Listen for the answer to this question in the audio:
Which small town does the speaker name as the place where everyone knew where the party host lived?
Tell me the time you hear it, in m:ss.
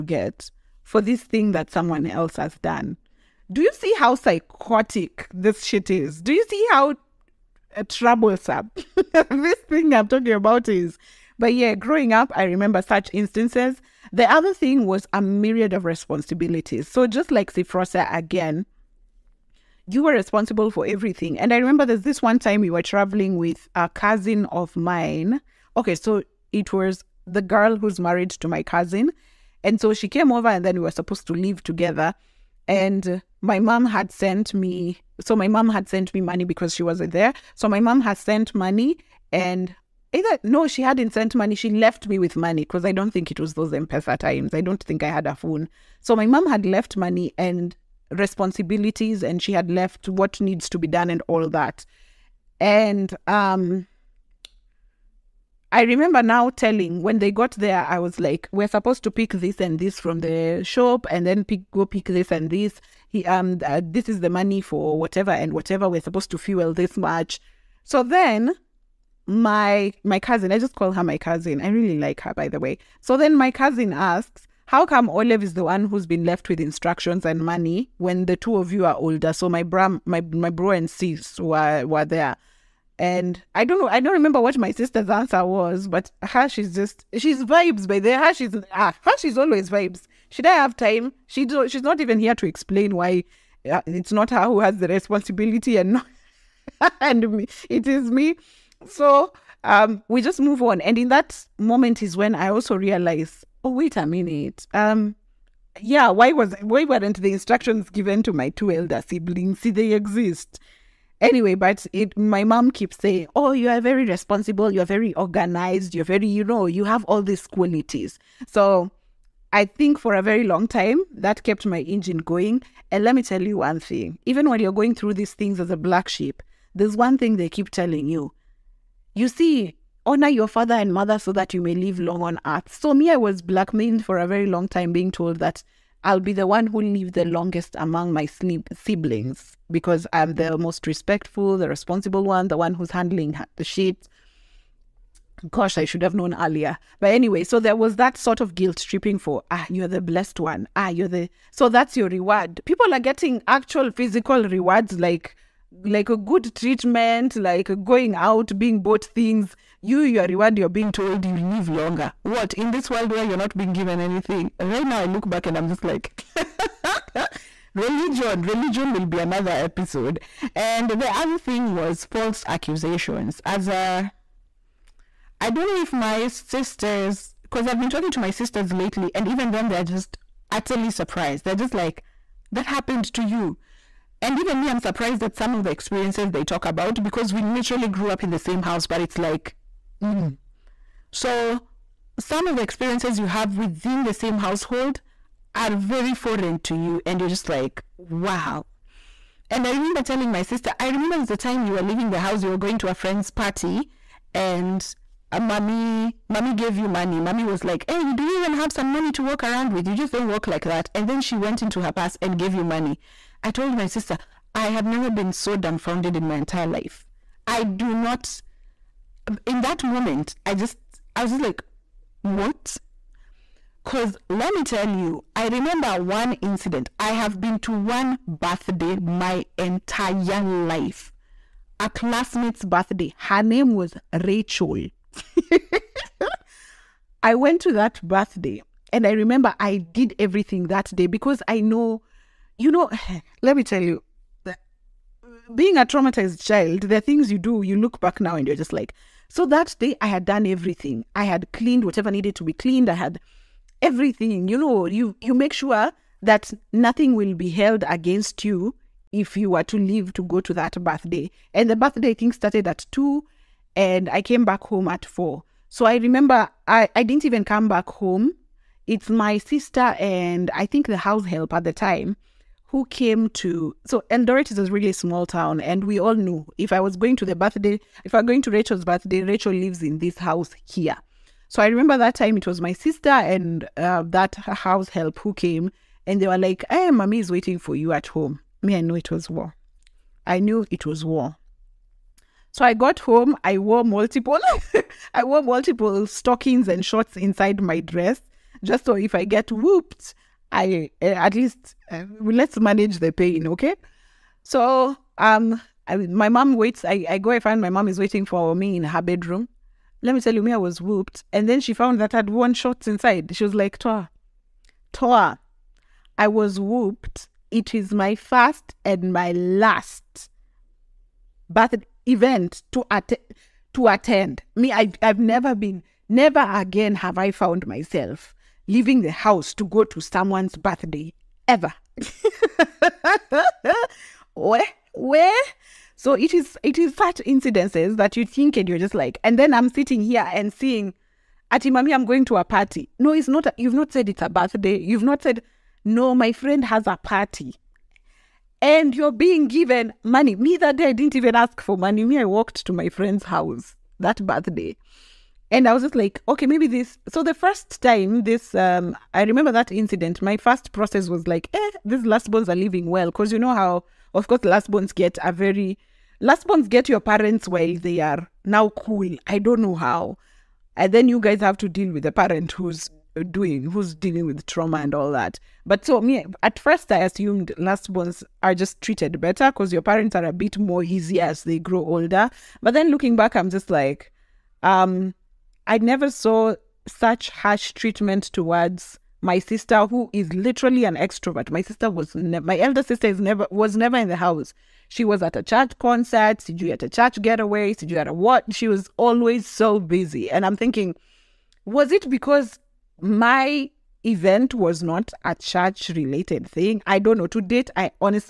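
4:34.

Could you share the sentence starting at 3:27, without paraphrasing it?
Mommy was like, "Hey, do you even have some money to walk around with?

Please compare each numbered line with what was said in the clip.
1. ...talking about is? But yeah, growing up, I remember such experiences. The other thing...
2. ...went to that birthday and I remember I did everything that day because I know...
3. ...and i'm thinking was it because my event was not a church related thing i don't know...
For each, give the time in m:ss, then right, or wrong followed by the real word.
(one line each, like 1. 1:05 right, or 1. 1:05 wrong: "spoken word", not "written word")
1. 0:10 wrong: "instances", not "experiences"
2. 3:57 right
3. 6:40 right.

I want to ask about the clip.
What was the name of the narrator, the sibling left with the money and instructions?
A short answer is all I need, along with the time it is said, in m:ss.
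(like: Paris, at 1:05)
Olive, at 1:15.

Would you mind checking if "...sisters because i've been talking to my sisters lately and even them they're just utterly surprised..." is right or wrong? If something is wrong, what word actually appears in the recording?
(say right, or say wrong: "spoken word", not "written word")
right.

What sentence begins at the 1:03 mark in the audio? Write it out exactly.
He, um, uh, this is the money for whatever and whatever.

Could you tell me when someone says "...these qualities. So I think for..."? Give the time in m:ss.
1:57.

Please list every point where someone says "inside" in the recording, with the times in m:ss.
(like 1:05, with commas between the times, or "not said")
4:57, 5:12.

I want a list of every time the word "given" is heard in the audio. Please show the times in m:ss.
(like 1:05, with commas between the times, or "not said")
1:47, 2:43, 5:49.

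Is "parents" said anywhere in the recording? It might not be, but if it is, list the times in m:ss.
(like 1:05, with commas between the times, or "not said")
6:06, 6:12, 6:19.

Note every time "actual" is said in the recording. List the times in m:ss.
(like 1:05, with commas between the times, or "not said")
2:33.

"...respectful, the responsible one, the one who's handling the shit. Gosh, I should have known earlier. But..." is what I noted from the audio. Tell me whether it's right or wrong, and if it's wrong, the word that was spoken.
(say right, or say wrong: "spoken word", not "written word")
right.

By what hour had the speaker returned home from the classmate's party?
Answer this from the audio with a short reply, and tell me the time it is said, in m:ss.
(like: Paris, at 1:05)
4, at 4:25.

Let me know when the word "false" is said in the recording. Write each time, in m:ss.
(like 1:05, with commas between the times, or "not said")
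2:52.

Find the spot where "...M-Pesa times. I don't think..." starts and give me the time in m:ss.
0:43.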